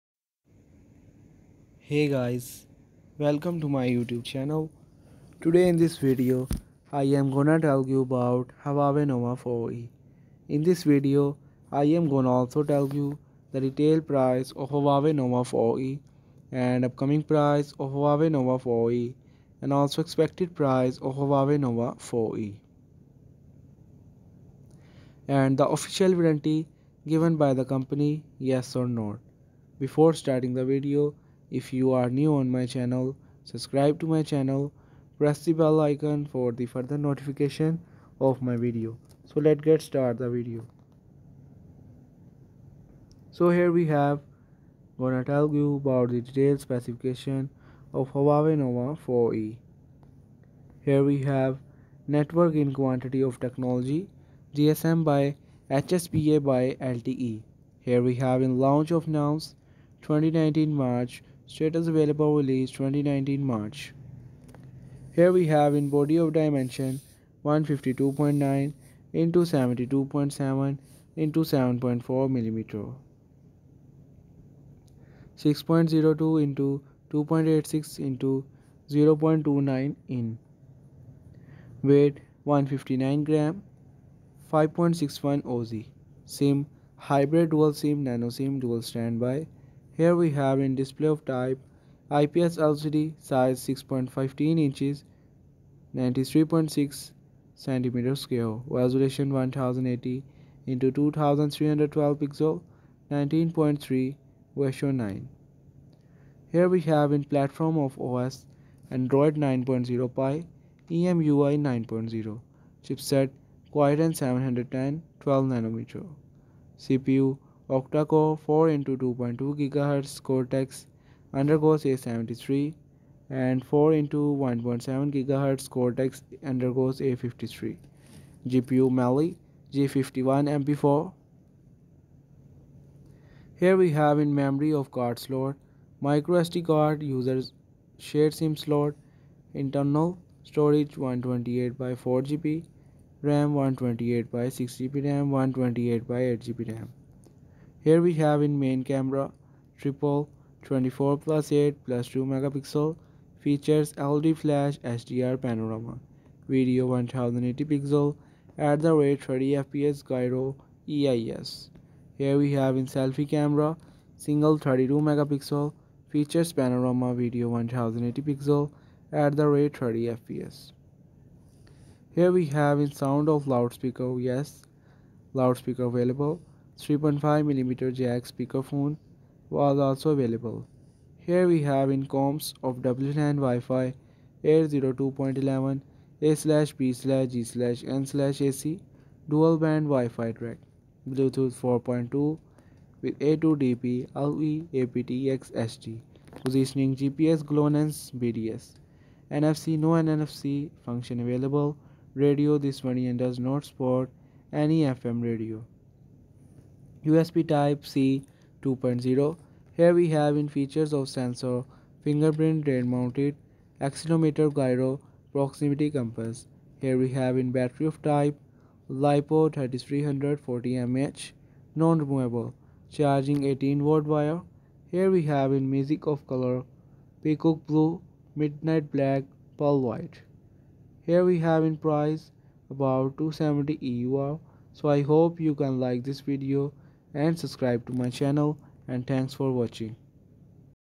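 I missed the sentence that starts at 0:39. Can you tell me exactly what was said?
So let's get start the video.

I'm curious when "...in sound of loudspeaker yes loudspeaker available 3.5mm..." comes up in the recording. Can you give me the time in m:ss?
2:52.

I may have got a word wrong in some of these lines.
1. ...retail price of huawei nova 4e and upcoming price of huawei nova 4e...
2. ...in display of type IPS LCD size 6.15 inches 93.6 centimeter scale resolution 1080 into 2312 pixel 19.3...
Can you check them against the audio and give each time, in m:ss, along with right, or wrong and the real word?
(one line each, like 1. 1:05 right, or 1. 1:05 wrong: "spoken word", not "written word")
1. 0:13 right
2. 1:30 right.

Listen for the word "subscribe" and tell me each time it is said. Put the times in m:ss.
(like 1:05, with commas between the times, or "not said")
0:33, 3:57.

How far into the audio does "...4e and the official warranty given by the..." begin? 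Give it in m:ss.
0:22.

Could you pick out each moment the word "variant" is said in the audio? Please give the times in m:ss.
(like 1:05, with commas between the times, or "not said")
3:22.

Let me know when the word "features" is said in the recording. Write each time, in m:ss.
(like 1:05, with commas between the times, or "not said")
2:33, 2:46, 3:30.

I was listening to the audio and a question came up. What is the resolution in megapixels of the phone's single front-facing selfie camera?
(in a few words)
32 megapixels.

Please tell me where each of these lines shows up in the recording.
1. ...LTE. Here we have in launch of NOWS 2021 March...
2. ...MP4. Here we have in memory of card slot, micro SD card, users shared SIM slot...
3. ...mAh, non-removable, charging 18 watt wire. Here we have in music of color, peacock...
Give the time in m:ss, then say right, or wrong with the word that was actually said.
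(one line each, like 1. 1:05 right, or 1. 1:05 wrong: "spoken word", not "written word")
1. 0:56 wrong: "2019", not "2021"
2. 2:10 right
3. 3:40 right.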